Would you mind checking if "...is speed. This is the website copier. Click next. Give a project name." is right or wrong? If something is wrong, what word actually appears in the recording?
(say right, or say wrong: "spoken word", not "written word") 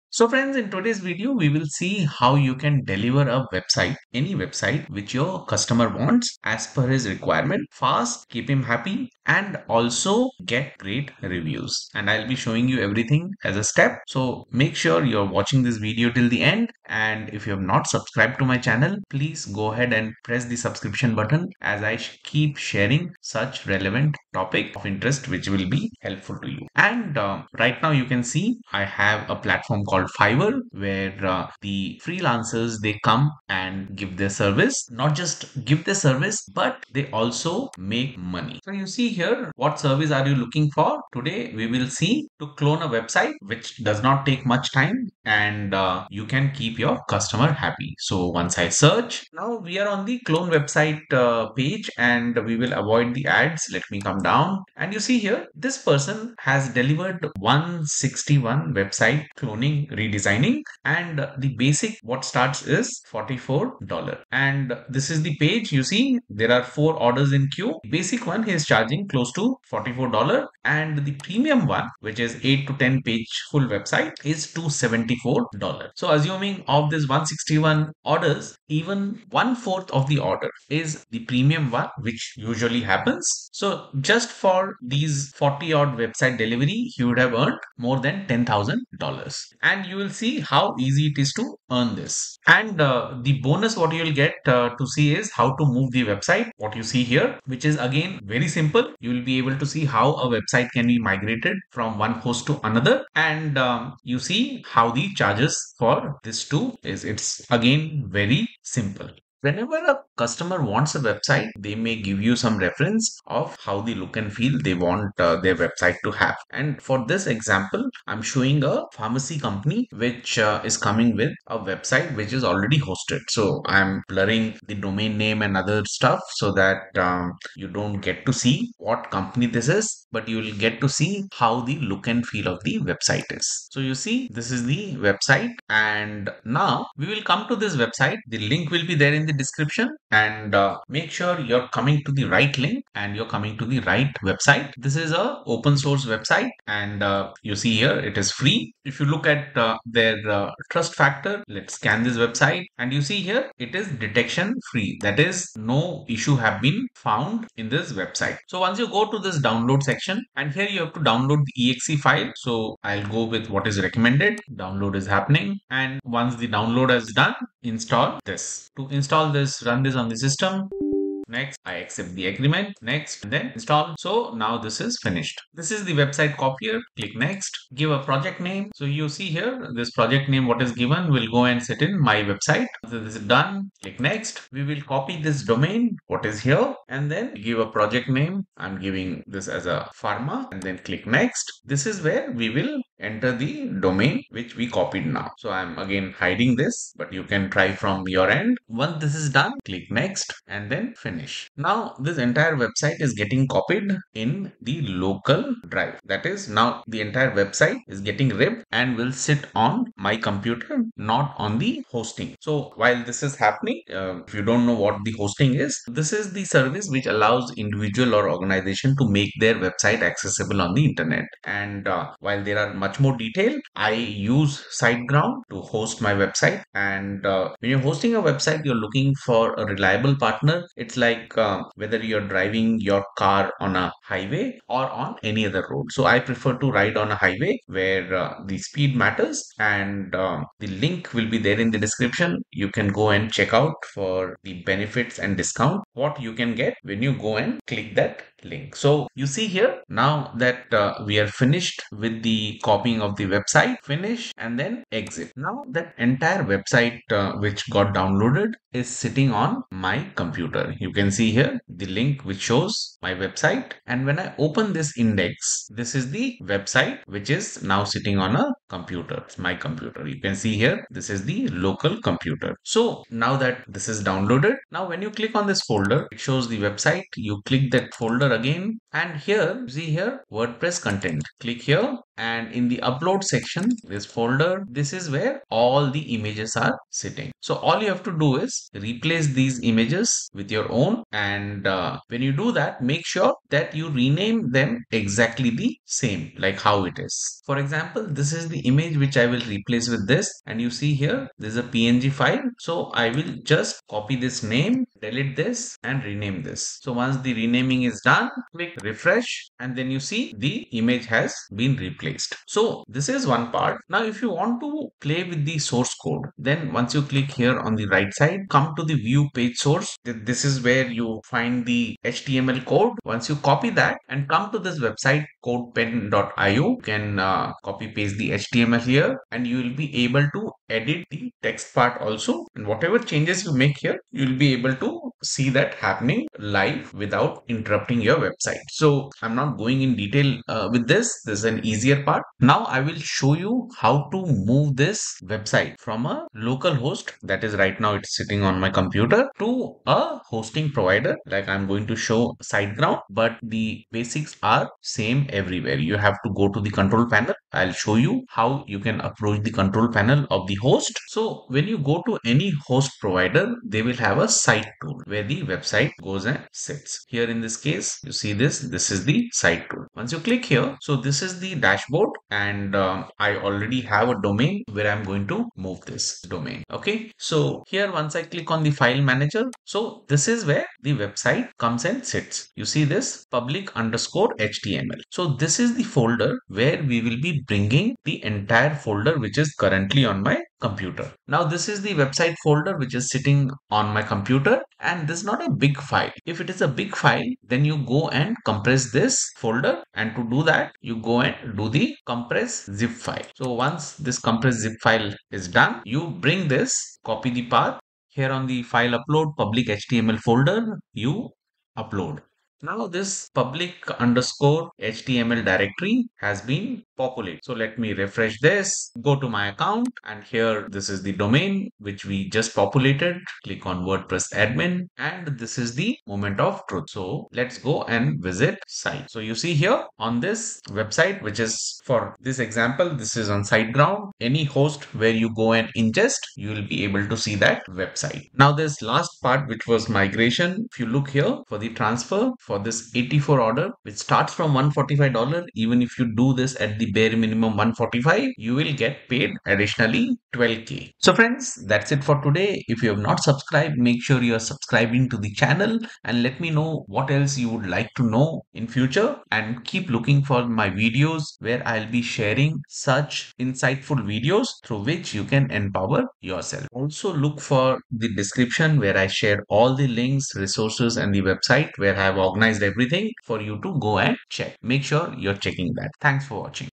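wrong: "finished", not "speed".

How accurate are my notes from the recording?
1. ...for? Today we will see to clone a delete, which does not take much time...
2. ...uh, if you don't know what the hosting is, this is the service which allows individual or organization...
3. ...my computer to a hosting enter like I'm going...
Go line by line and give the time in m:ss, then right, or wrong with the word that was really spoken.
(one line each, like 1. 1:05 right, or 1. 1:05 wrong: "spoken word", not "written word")
1. 0:40 wrong: "website", not "delete"
2. 3:33 right
3. 5:48 wrong: "provider", not "enter".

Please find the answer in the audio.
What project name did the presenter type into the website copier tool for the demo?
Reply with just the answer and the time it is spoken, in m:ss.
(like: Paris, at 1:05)
pharma, at 3:10.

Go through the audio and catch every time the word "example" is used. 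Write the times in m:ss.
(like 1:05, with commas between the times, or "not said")
1:57, 4:57, 7:12.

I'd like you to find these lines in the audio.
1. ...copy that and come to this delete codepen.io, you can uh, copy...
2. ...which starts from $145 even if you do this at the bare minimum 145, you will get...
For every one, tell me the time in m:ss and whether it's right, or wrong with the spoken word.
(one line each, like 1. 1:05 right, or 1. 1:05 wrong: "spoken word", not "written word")
1. 5:23 wrong: "website", not "delete"
2. 7:23 right.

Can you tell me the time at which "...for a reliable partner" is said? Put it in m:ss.
3:49.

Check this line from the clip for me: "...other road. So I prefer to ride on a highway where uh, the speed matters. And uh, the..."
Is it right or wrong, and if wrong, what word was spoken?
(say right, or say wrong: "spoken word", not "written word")
right.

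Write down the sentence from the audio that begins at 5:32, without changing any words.
And whatever changes you make here, you'll be able to see that happening live without interrupting your website.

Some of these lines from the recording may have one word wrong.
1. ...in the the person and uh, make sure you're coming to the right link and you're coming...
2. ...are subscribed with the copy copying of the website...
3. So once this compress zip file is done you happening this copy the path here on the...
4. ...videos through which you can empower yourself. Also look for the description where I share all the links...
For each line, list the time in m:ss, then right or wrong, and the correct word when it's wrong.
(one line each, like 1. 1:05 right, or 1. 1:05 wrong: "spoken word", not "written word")
1. 2:19 wrong: "description", not "person"
2. 4:11 wrong: "finished", not "subscribed"
3. 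6:43 wrong: "bring", not "happening"
4. 7:44 right.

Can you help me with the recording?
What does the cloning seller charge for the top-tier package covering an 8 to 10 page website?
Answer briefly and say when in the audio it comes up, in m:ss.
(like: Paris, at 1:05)
$274, at 1:14.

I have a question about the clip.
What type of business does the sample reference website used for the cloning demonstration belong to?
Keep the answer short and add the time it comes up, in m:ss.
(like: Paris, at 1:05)
pharmacy company, at 1:58.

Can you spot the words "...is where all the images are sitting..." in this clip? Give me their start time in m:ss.
4:44.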